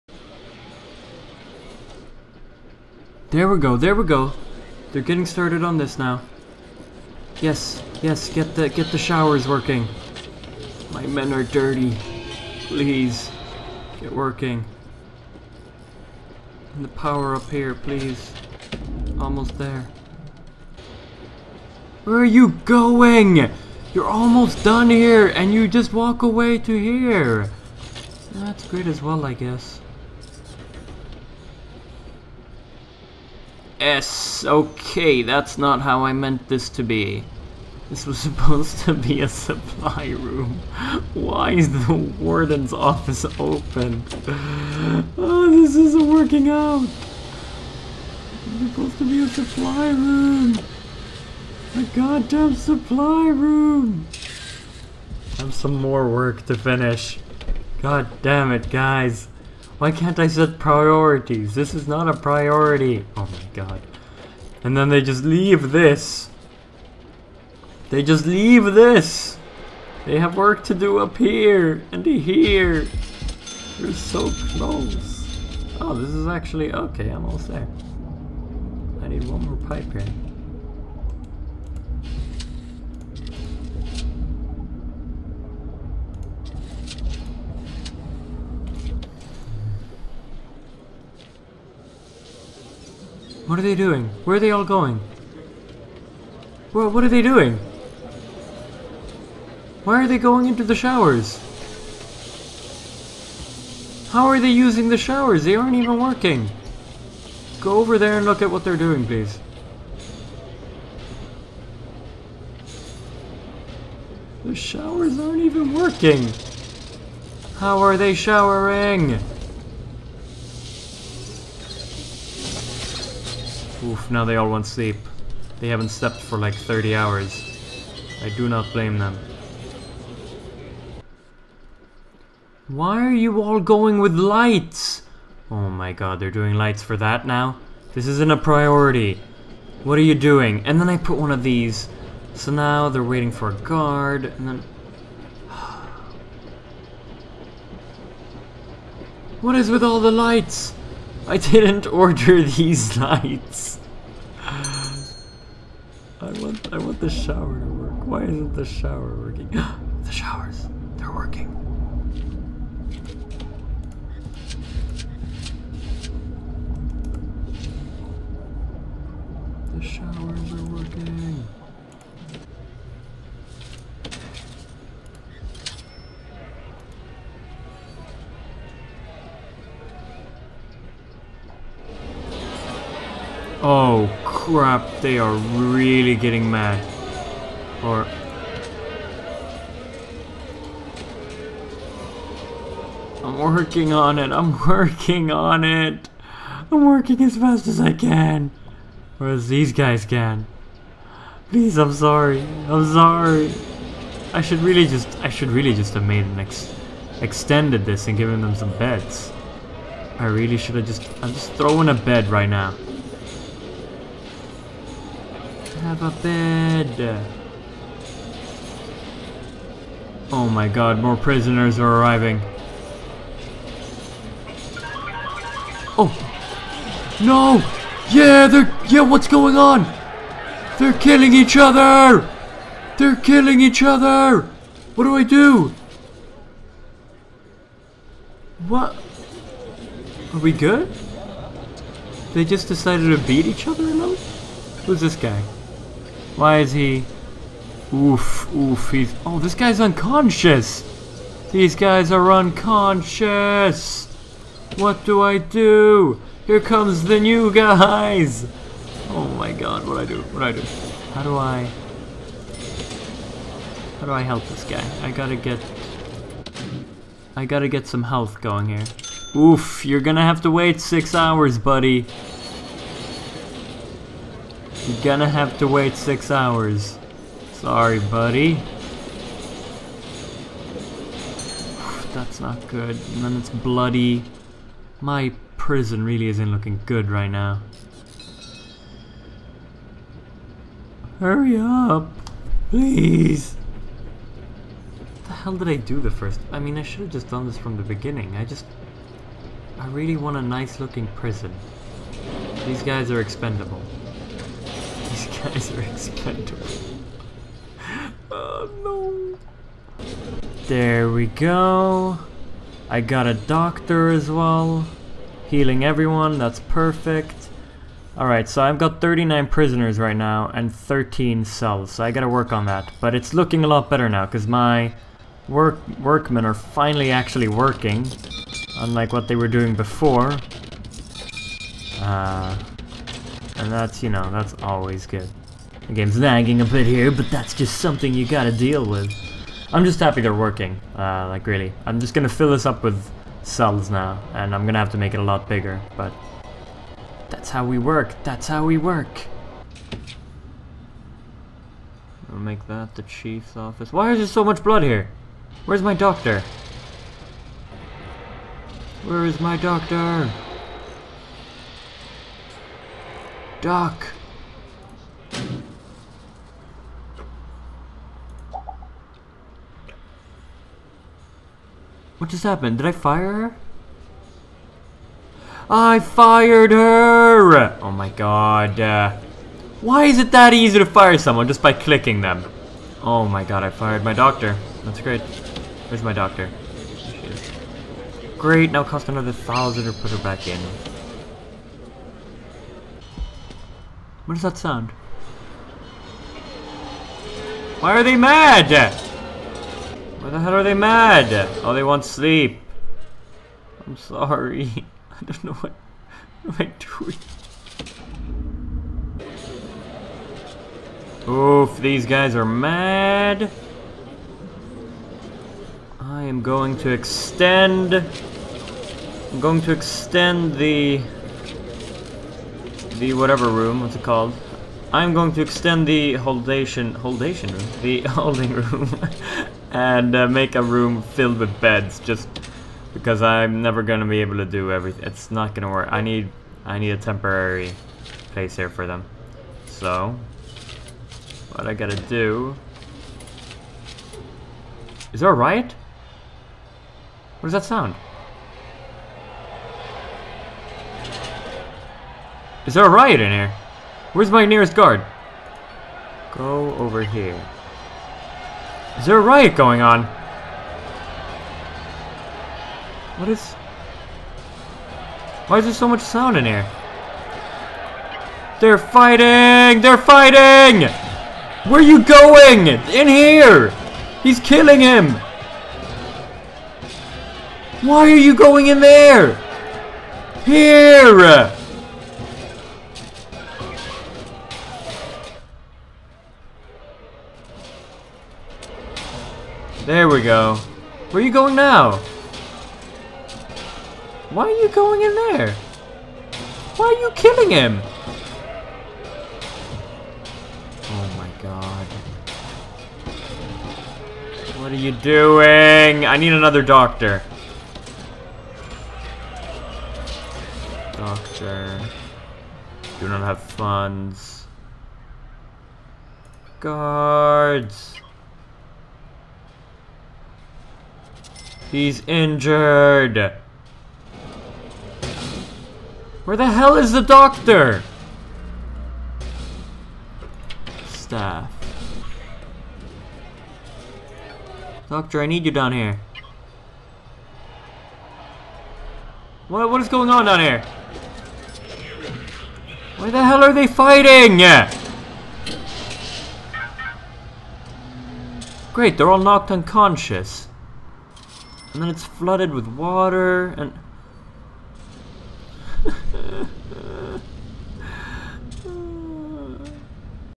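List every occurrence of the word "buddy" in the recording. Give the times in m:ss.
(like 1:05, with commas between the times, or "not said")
4:31, 4:37.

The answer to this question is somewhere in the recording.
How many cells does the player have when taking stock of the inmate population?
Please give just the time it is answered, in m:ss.
5:20.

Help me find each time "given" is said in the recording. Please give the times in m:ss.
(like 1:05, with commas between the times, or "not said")
3:28.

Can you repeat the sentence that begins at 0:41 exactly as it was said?
Why is the warden's office open?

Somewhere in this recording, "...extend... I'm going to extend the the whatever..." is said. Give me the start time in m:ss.
6:56.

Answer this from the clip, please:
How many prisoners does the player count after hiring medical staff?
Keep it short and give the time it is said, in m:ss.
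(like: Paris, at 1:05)
39, at 5:19.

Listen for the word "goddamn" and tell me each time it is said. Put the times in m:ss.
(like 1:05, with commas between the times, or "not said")
0:51.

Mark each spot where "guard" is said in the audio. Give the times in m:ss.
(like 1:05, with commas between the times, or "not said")
2:23, 7:34, 8:36.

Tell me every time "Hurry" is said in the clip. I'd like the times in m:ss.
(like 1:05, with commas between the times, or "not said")
4:51.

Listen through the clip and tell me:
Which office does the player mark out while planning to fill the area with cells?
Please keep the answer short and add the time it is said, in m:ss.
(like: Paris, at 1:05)
Chief's office, at 5:53.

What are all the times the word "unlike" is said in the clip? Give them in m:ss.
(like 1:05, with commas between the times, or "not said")
5:28.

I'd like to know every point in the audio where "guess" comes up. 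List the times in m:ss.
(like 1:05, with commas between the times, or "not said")
0:29.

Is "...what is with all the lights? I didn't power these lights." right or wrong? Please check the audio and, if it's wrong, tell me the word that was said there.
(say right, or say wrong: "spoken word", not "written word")
wrong: "order", not "power".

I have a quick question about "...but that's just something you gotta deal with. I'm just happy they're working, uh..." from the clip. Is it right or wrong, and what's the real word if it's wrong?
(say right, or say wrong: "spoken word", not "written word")
right.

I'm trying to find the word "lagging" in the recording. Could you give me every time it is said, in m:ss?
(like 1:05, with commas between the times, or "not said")
5:36.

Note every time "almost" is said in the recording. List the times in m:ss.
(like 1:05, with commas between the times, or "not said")
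0:19, 0:24, 1:17.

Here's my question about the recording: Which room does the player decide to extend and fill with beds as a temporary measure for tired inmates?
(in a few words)
Holding room.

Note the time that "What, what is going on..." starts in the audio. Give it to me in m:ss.
8:59.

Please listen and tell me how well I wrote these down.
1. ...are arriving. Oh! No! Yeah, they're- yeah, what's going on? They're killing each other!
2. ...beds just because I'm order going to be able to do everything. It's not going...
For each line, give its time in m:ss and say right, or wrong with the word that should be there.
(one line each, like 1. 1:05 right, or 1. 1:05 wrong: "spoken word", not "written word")
1. 3:41 right
2. 7:11 wrong: "never", not "order".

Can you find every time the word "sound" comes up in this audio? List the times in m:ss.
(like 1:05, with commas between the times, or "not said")
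6:34, 7:27, 7:46.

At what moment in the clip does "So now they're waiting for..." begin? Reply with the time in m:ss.
2:22.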